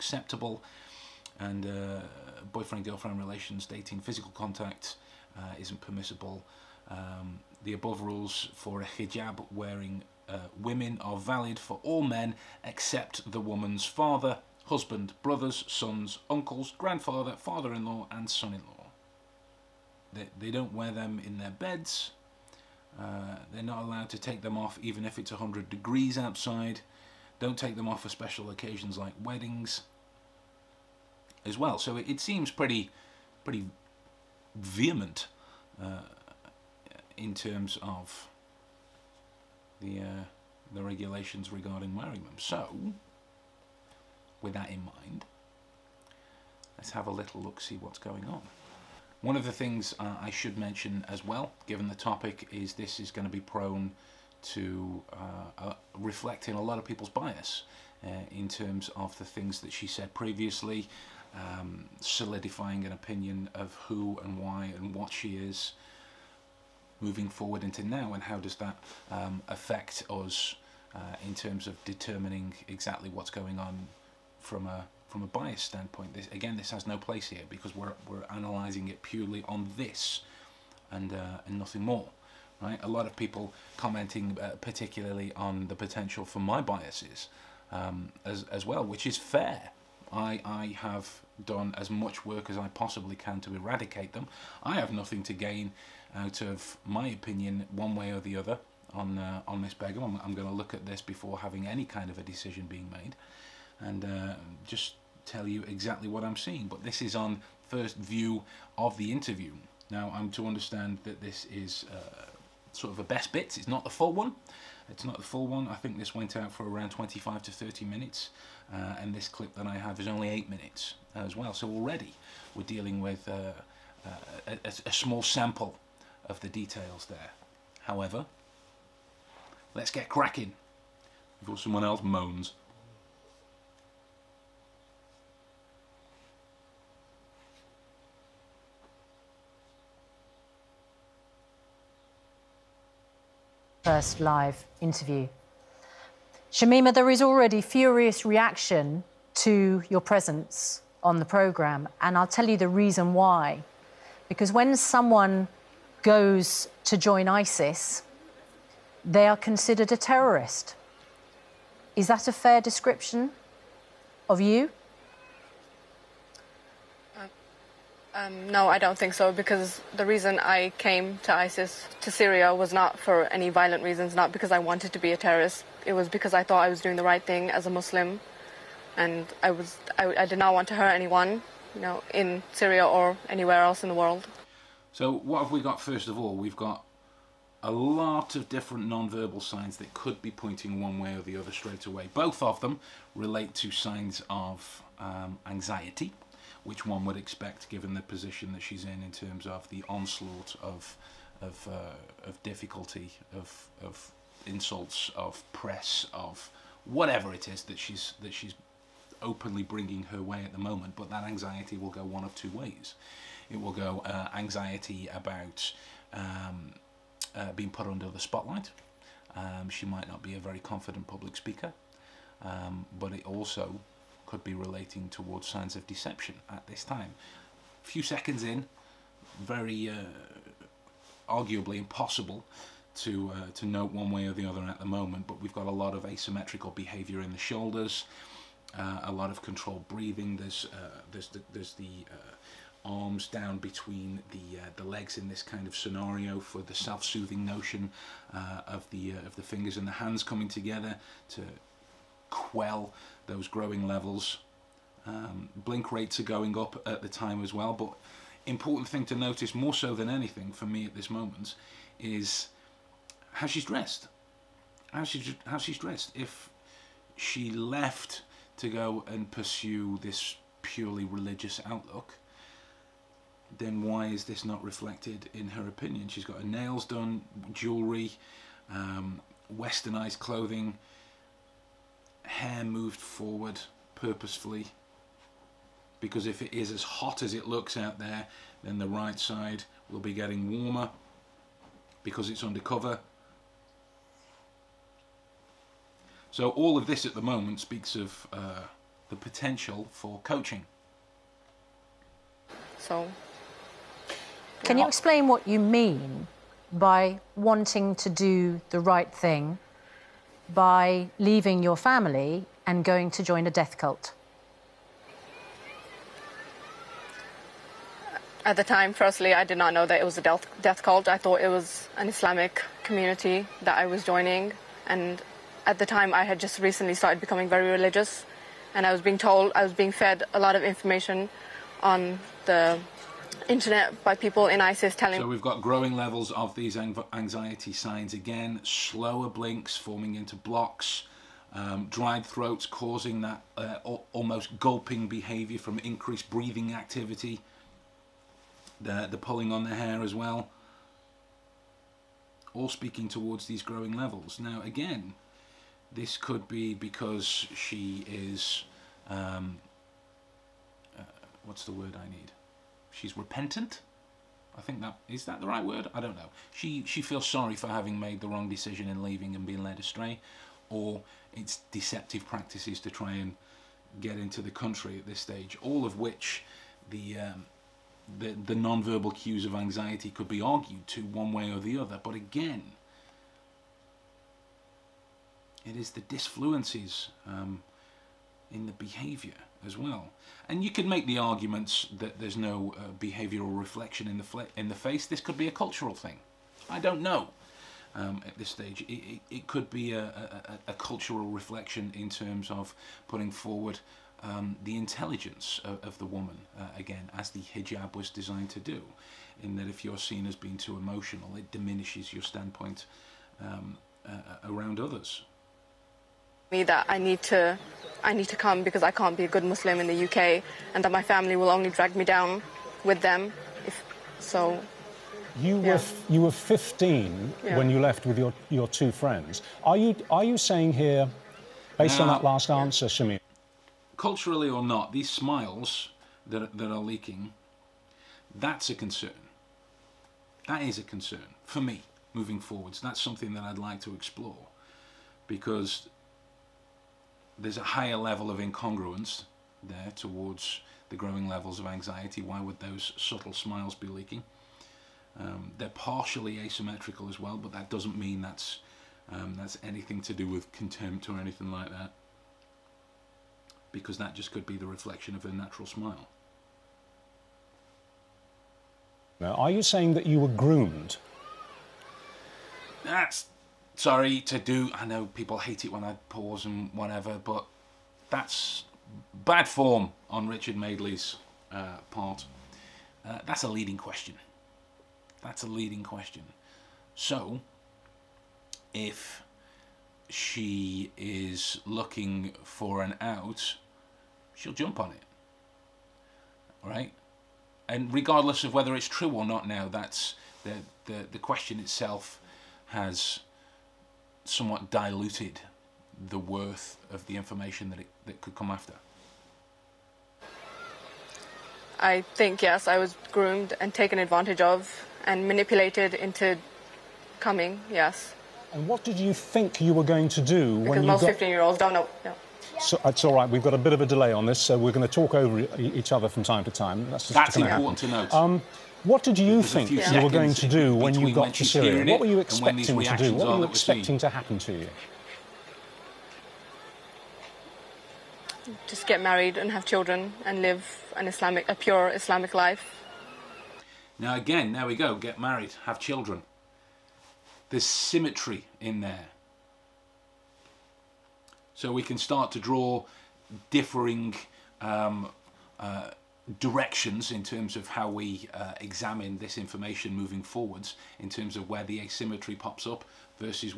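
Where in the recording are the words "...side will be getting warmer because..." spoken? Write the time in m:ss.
4:49.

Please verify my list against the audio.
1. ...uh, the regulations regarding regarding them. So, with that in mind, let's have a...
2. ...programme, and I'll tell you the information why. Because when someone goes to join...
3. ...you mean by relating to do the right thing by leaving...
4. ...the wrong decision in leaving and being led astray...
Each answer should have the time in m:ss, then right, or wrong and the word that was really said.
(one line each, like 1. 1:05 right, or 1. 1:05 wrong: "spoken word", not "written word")
1. 0:40 wrong: "wearing", not "regarding"
2. 2:31 wrong: "reason", not "information"
3. 5:05 wrong: "wanting", not "relating"
4. 6:08 right.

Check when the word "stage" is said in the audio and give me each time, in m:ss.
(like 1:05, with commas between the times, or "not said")
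6:15, 6:38.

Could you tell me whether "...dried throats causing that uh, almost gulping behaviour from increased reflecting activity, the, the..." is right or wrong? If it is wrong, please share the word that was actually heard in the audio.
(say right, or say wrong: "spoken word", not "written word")
wrong: "breathing", not "reflecting".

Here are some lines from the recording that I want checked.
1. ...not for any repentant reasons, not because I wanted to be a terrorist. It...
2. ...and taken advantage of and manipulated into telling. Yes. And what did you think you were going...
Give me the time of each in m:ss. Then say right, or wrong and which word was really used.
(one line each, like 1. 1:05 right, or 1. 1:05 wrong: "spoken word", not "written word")
1. 2:52 wrong: "violent", not "repentant"
2. 8:33 wrong: "coming", not "telling".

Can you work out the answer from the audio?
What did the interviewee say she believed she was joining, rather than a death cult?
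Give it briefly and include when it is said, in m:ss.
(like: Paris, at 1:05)
An Islamic community, at 5:22.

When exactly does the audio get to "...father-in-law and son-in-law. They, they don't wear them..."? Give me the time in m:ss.
0:17.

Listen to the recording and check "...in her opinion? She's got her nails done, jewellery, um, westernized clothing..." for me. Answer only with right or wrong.
right.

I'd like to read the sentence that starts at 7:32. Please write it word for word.
Why would those subtle smiles be leaking?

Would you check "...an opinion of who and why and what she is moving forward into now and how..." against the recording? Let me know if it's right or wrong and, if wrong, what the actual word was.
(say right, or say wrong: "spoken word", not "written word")
right.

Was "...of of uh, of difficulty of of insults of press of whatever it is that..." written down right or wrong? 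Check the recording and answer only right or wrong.
right.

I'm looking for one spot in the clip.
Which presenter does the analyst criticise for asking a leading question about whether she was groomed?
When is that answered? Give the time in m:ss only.
8:00.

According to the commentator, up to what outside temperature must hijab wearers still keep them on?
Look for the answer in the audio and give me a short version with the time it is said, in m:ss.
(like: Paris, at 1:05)
100 degrees, at 0:25.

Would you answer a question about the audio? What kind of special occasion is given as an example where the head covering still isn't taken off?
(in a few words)
Weddings.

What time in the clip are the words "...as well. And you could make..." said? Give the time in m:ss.
6:29.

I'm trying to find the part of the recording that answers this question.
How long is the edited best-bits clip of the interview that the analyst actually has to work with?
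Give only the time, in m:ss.
2:00.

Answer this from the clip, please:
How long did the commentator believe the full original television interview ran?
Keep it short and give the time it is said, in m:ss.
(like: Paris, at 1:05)
25 to 30 minutes, at 1:56.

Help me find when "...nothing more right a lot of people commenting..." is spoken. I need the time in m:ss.
1:21.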